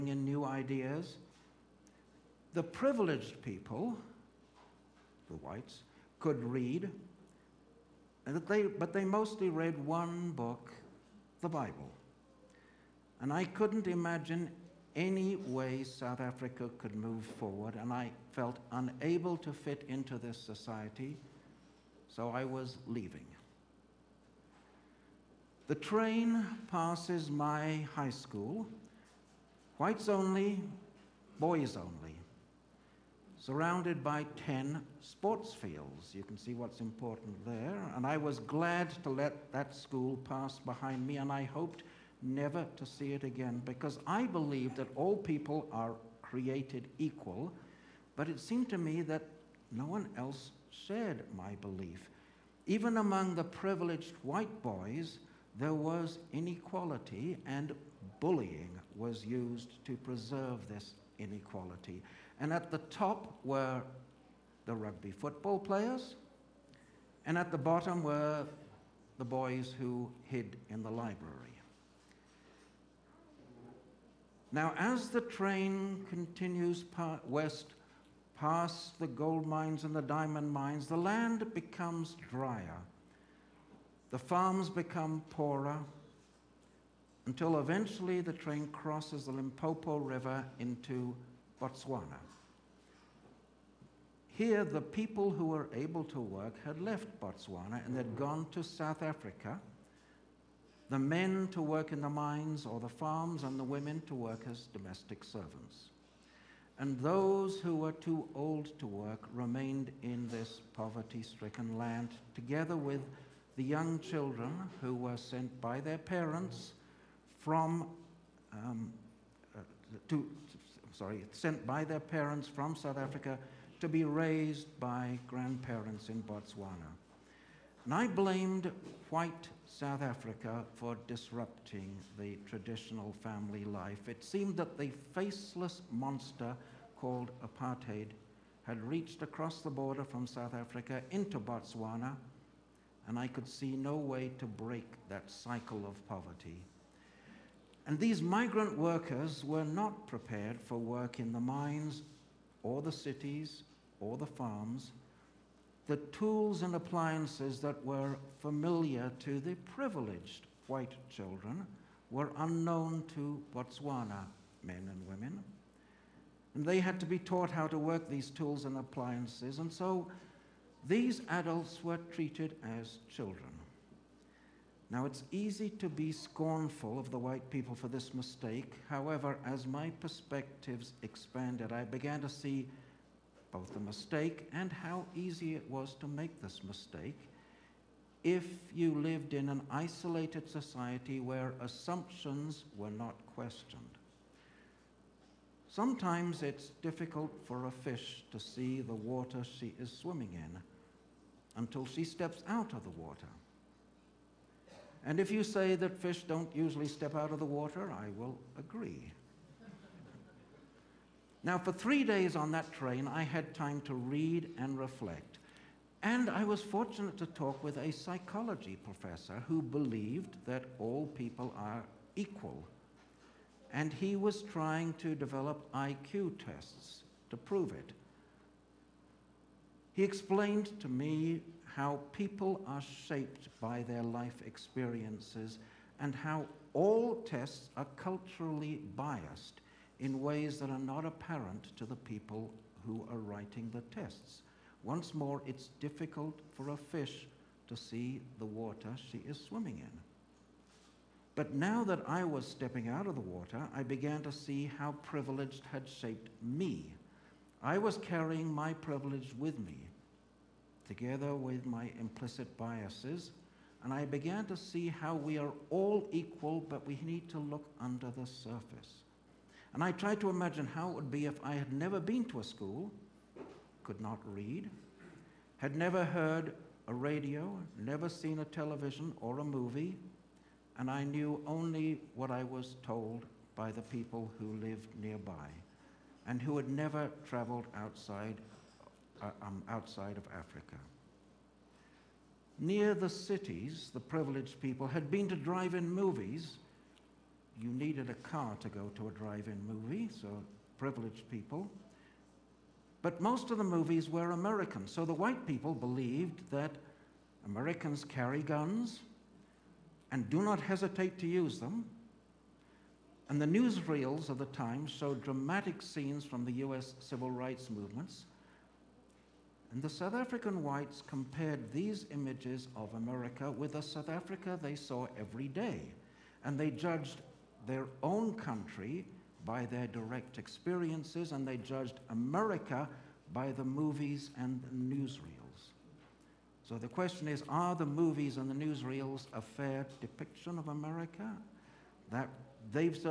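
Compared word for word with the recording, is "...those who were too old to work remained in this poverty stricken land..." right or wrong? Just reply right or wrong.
right.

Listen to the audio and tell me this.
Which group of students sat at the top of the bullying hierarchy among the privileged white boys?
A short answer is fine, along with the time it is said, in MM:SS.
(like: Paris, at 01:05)
rugby football players, at 01:04.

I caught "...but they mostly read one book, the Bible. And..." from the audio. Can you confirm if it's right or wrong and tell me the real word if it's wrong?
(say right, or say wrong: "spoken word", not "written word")
right.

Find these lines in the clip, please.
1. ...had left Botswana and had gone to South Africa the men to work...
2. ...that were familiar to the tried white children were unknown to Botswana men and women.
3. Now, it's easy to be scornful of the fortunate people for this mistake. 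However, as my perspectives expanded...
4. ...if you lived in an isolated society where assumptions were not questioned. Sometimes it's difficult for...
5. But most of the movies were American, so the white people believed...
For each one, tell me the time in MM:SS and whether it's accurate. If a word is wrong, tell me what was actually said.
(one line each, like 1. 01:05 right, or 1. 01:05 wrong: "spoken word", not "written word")
1. 01:36 right
2. 02:37 wrong: "privileged", not "tried"
3. 02:54 wrong: "white", not "fortunate"
4. 03:08 right
5. 05:03 right.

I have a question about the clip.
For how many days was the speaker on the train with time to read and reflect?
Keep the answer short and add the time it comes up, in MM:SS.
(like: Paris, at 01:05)
3, at 03:31.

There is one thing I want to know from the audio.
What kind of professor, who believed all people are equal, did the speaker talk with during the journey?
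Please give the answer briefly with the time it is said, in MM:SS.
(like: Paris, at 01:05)
psychology professor, at 03:37.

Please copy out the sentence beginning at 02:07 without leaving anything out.
And I blamed white South Africa for disrupting the traditional family life.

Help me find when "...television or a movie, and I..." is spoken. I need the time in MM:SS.
04:38.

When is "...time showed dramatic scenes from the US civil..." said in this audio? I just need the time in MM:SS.
05:14.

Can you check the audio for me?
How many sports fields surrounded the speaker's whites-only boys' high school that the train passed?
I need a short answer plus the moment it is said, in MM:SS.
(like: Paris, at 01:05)
10, at 00:34.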